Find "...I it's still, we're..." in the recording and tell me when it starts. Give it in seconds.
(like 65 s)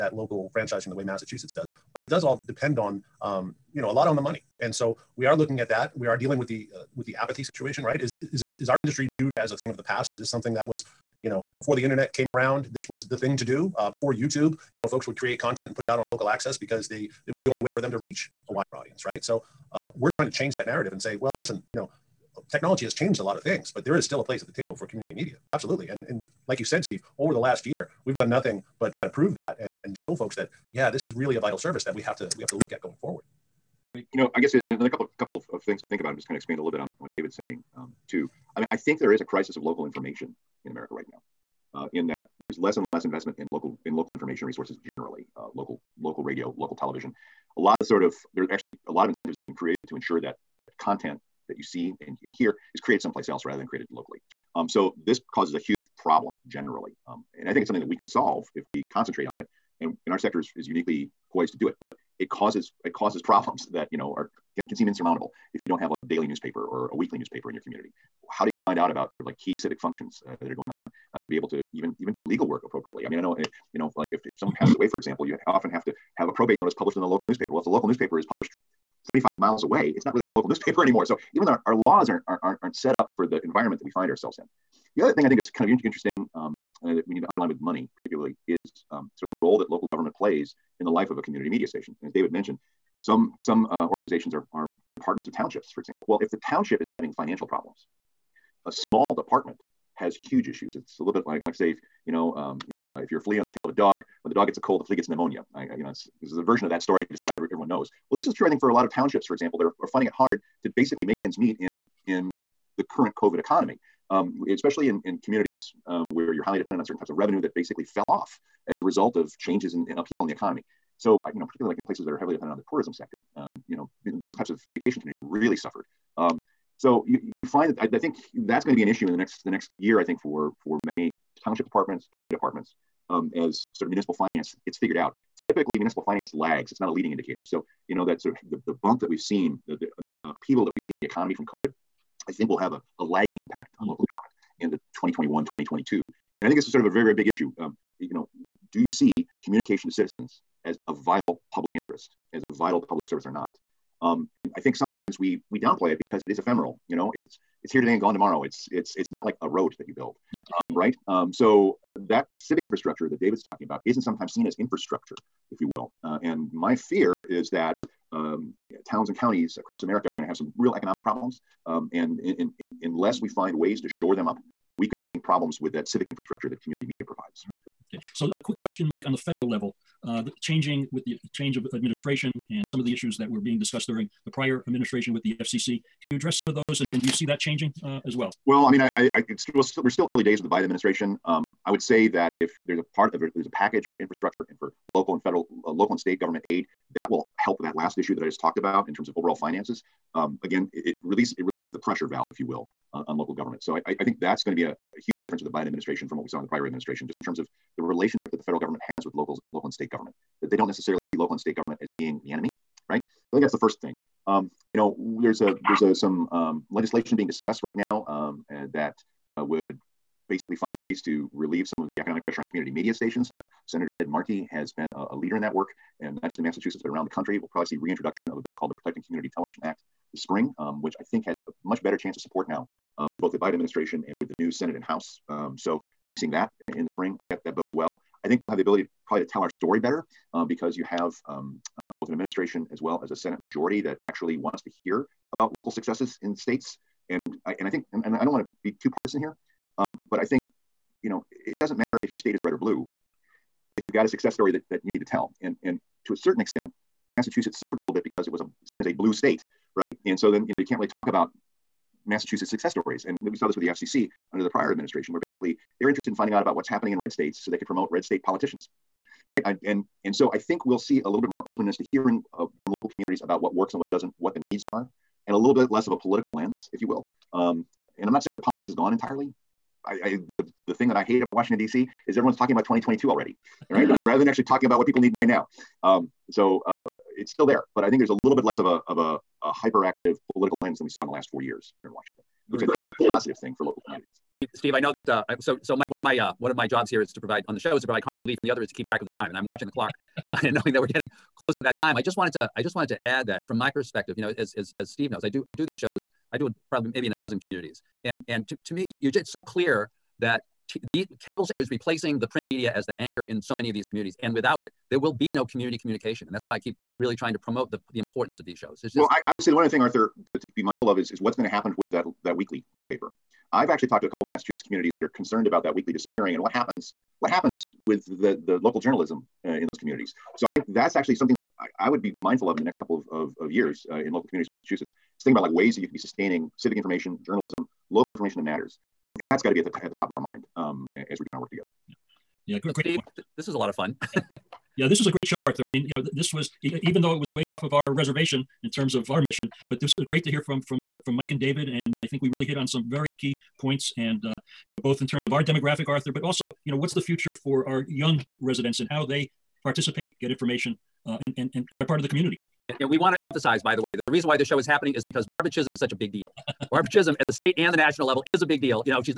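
189 s.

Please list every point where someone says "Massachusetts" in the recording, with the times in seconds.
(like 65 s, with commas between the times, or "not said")
1 s, 226 s, 257 s, 262 s, 324 s, 334 s.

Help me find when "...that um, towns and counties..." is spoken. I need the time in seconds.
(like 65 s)
167 s.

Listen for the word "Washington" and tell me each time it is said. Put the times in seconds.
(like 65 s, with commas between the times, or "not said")
281 s, 291 s.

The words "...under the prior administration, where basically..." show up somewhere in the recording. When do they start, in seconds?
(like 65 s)
264 s.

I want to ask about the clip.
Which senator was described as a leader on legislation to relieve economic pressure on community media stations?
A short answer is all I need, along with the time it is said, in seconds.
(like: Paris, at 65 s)
Ed Markey, at 223 s.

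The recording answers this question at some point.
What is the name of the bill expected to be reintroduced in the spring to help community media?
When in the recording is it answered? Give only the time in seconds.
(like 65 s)
228 s.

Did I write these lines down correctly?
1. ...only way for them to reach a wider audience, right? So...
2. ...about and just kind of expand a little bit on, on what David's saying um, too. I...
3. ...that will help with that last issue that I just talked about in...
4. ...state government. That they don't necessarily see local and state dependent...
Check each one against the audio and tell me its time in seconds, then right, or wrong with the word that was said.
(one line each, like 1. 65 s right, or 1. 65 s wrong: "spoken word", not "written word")
1. 17 s right
2. 35 s right
3. 196 s right
4. 209 s wrong: "government", not "dependent".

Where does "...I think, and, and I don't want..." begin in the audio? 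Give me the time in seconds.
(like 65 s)
247 s.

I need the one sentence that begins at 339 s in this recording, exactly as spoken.
And, and that's got to be at the, t- at the top of our mind um, as we're doing our work together.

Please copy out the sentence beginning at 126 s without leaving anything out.
Um, so you you find that I, I, think that's going to be an issue in the next the next year.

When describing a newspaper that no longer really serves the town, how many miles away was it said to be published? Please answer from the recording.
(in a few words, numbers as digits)
75.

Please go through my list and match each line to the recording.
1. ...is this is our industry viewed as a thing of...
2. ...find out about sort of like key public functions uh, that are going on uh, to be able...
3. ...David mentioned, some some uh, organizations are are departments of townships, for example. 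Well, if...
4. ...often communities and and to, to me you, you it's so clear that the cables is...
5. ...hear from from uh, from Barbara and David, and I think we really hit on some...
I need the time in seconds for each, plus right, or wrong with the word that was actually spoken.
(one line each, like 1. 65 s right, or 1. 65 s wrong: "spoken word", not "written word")
1. 8 s right
2. 68 s wrong: "civic", not "public"
3. 92 s right
4. 307 s wrong: "dozen", not "often"
5. 350 s wrong: "Mike", not "Barbara".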